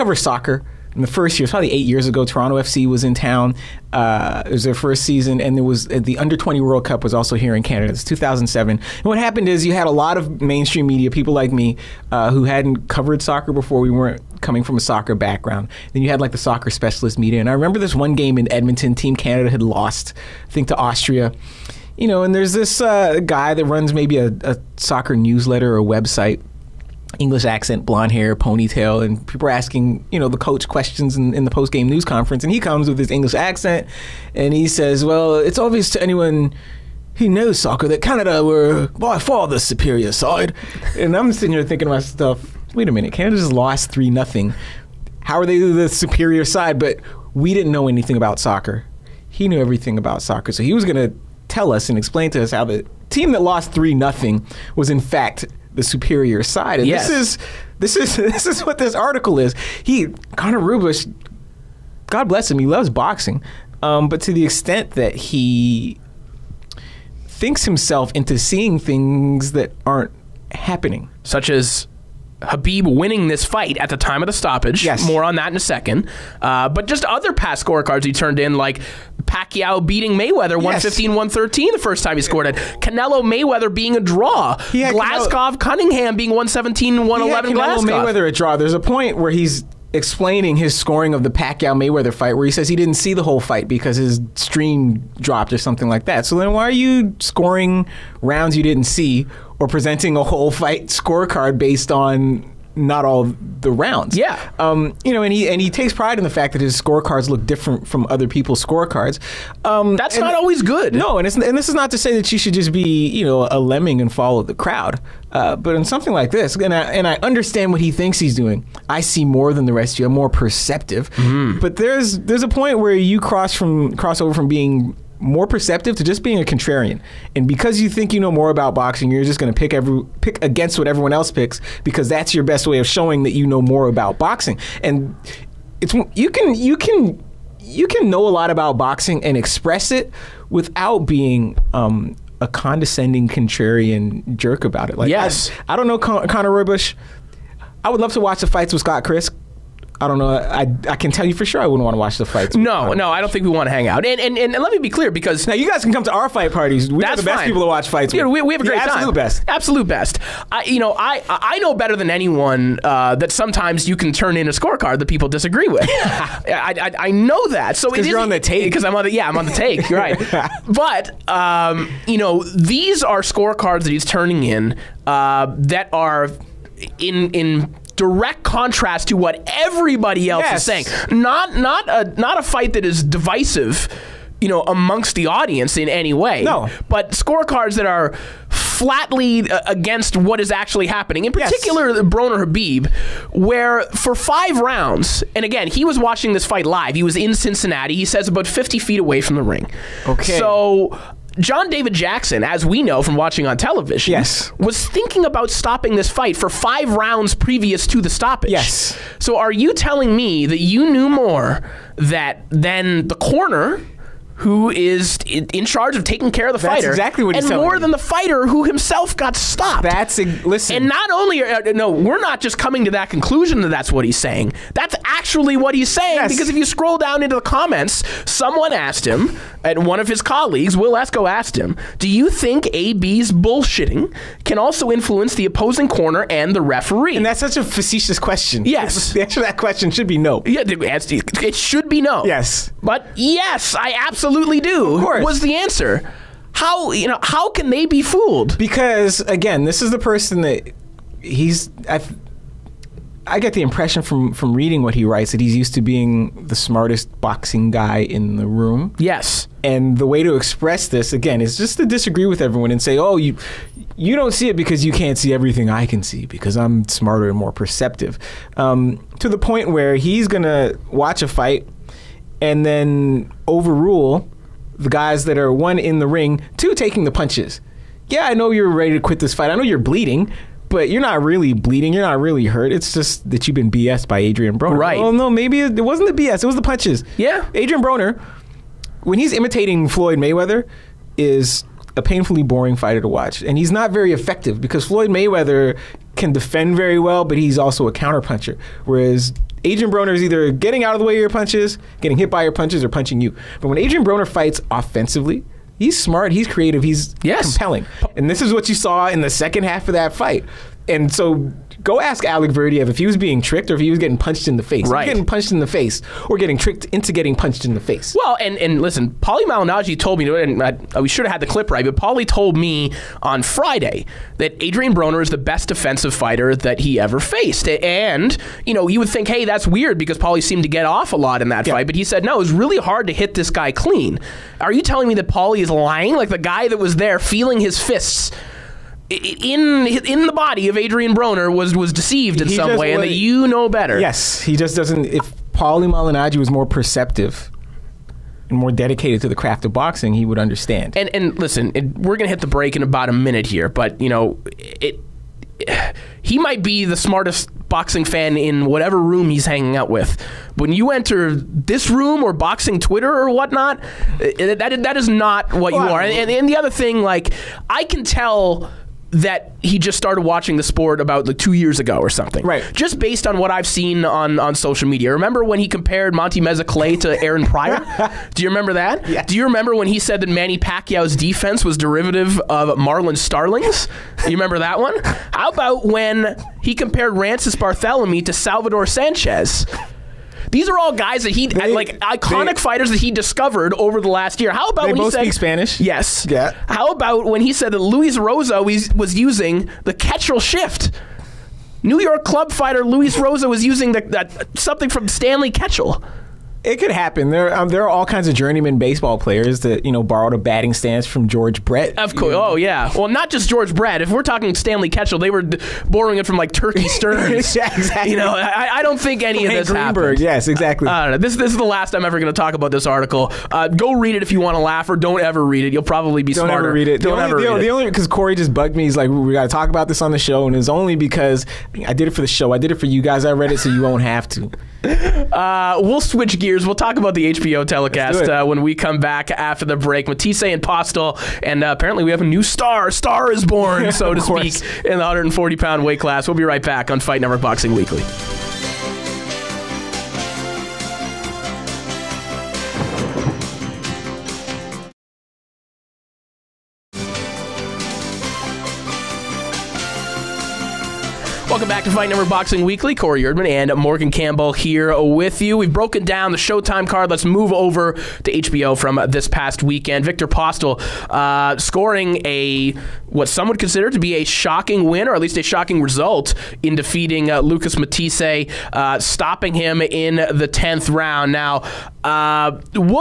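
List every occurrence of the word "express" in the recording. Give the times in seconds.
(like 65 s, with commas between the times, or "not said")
139 s, 260 s.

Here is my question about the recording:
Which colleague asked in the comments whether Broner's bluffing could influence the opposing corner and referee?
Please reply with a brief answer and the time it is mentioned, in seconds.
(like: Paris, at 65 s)
Wil Esco, at 230 s.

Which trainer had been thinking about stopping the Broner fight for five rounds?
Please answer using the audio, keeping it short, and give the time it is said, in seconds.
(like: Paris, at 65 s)
John David Jackson, at 201 s.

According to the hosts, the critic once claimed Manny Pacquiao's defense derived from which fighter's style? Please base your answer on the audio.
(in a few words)
Marlon Starling.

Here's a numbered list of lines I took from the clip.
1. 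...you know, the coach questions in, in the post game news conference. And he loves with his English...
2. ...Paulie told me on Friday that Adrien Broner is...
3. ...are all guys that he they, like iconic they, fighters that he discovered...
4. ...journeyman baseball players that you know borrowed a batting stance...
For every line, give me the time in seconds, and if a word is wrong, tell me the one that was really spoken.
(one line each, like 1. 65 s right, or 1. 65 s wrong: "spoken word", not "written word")
1. 30 s wrong: "comes", not "loves"
2. 321 s right
3. 390 s right
4. 408 s right.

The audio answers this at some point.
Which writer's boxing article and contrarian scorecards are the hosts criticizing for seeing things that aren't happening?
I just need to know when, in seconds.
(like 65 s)
60 s.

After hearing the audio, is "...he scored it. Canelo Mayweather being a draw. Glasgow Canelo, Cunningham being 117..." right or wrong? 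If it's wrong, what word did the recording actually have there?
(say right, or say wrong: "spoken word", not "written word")
right.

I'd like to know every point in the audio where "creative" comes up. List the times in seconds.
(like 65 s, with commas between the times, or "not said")
306 s.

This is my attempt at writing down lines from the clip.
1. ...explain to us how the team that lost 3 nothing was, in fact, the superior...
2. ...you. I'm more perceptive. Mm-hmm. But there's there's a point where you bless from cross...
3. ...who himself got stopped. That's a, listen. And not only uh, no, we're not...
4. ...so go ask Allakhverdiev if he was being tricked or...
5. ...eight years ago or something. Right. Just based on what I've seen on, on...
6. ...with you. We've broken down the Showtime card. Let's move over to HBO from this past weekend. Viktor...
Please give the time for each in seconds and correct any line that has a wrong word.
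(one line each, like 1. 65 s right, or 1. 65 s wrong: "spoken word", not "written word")
1. 51 s right
2. 119 s wrong: "cross", not "bless"
3. 218 s right
4. 311 s right
5. 371 s wrong: "two", not "eight"
6. 465 s right.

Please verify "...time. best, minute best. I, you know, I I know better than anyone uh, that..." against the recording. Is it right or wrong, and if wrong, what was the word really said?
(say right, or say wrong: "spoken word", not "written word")
wrong: "absolute", not "minute".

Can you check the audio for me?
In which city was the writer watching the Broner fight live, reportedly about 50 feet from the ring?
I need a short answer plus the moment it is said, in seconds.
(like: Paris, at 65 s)
Cincinnati, at 197 s.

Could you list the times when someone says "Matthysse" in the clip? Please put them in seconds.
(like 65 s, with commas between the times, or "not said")
440 s, 477 s.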